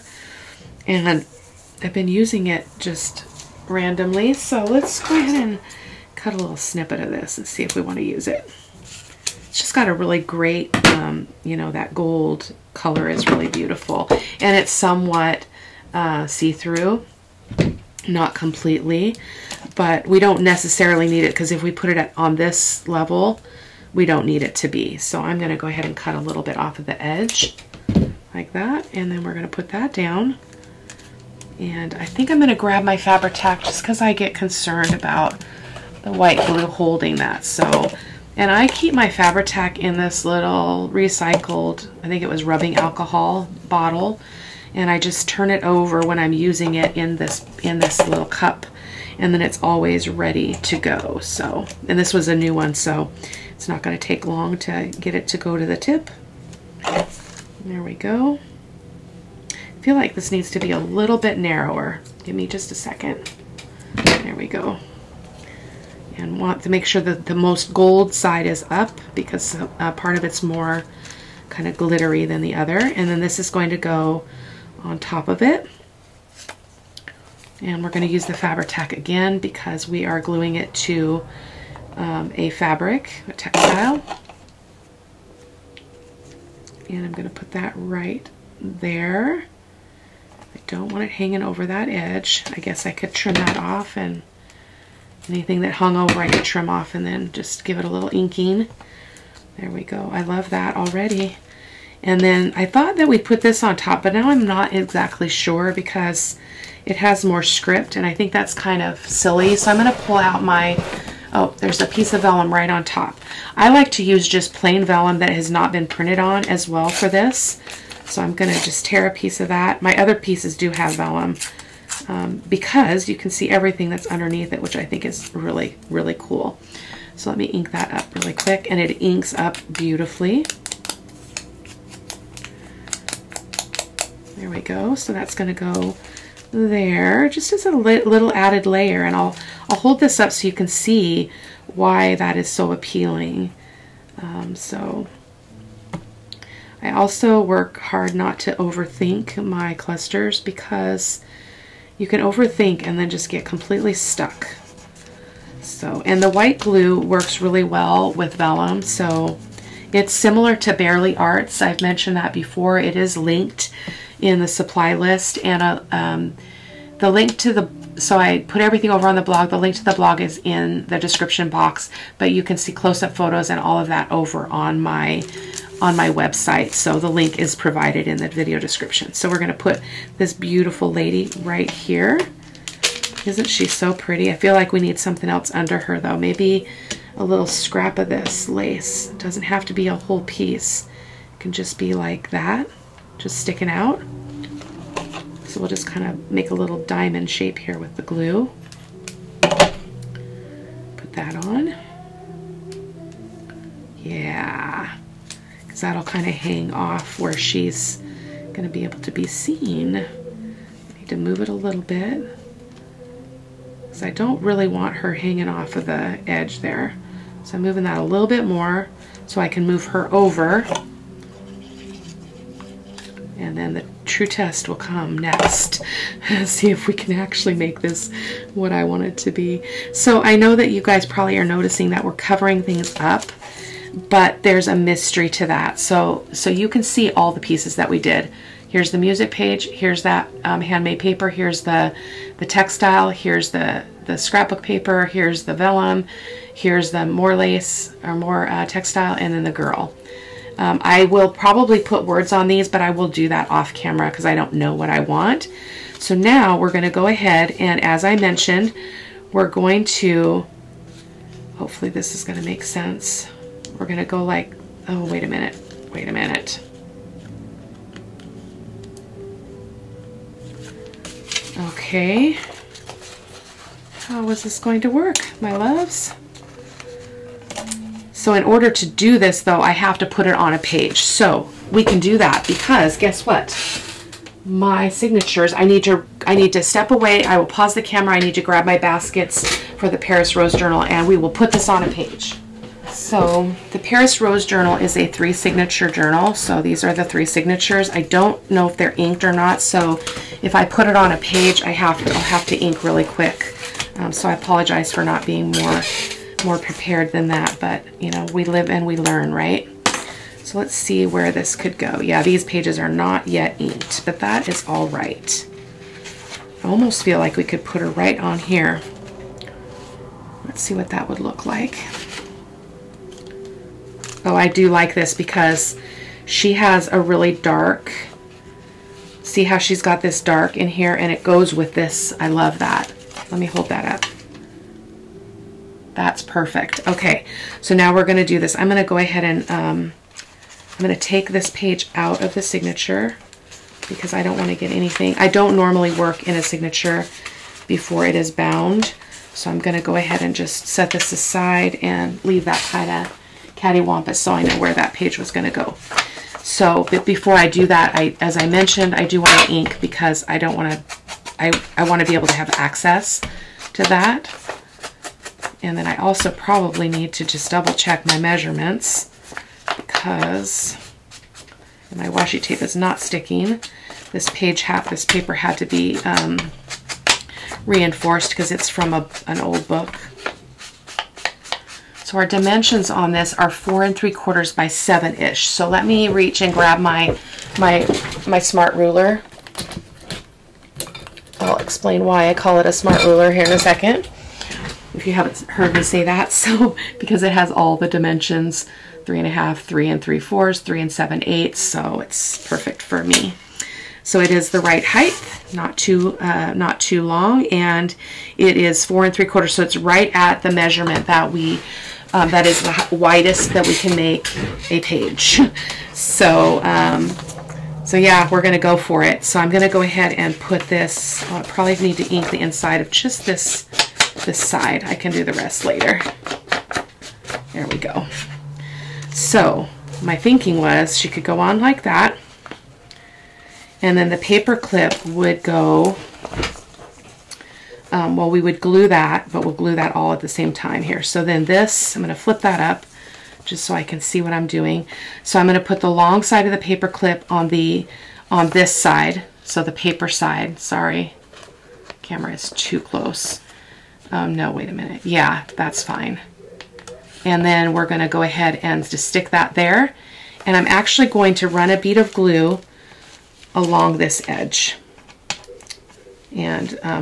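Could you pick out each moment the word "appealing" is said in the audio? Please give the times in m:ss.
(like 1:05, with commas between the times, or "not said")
2:22.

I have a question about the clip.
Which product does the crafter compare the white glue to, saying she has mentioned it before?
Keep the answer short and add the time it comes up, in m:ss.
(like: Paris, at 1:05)
Bearly Arts, at 2:40.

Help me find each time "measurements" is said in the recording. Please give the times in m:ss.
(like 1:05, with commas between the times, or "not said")
6:08, 6:50.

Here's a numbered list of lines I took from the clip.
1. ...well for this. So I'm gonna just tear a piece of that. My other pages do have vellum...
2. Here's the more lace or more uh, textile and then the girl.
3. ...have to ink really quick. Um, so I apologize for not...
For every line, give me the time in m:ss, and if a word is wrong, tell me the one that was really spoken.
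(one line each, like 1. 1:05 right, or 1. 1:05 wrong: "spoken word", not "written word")
1. 1:56 wrong: "pieces", not "pages"
2. 4:06 right
3. 5:02 right.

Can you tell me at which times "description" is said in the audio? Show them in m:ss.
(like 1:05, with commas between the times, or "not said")
2:50, 2:58.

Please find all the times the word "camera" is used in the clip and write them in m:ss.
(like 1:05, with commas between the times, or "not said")
4:13, 4:47, 7:32.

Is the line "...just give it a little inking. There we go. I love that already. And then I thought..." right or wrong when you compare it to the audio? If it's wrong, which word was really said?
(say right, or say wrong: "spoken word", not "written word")
right.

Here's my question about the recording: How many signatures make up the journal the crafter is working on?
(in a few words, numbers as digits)
3.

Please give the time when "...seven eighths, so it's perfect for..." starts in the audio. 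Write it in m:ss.
6:40.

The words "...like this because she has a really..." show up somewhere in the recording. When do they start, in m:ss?
5:24.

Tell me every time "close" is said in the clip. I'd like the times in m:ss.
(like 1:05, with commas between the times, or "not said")
2:52, 7:32.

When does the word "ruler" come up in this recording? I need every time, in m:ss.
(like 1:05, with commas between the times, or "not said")
6:28, 6:33.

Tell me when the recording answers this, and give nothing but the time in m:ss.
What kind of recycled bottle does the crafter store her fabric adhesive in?
0:42.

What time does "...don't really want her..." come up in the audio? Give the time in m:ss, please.
3:34.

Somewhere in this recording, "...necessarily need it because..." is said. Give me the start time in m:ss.
0:20.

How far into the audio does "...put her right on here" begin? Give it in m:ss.
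5:17.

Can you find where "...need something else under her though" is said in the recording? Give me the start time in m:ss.
3:04.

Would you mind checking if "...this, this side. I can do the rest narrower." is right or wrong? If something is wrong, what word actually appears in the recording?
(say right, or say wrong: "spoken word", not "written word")
wrong: "later", not "narrower".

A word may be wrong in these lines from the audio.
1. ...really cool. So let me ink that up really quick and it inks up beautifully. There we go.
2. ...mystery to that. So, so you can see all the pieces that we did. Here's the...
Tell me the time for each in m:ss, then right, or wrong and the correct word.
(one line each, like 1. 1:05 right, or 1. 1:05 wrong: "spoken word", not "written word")
1. 2:05 right
2. 3:54 right.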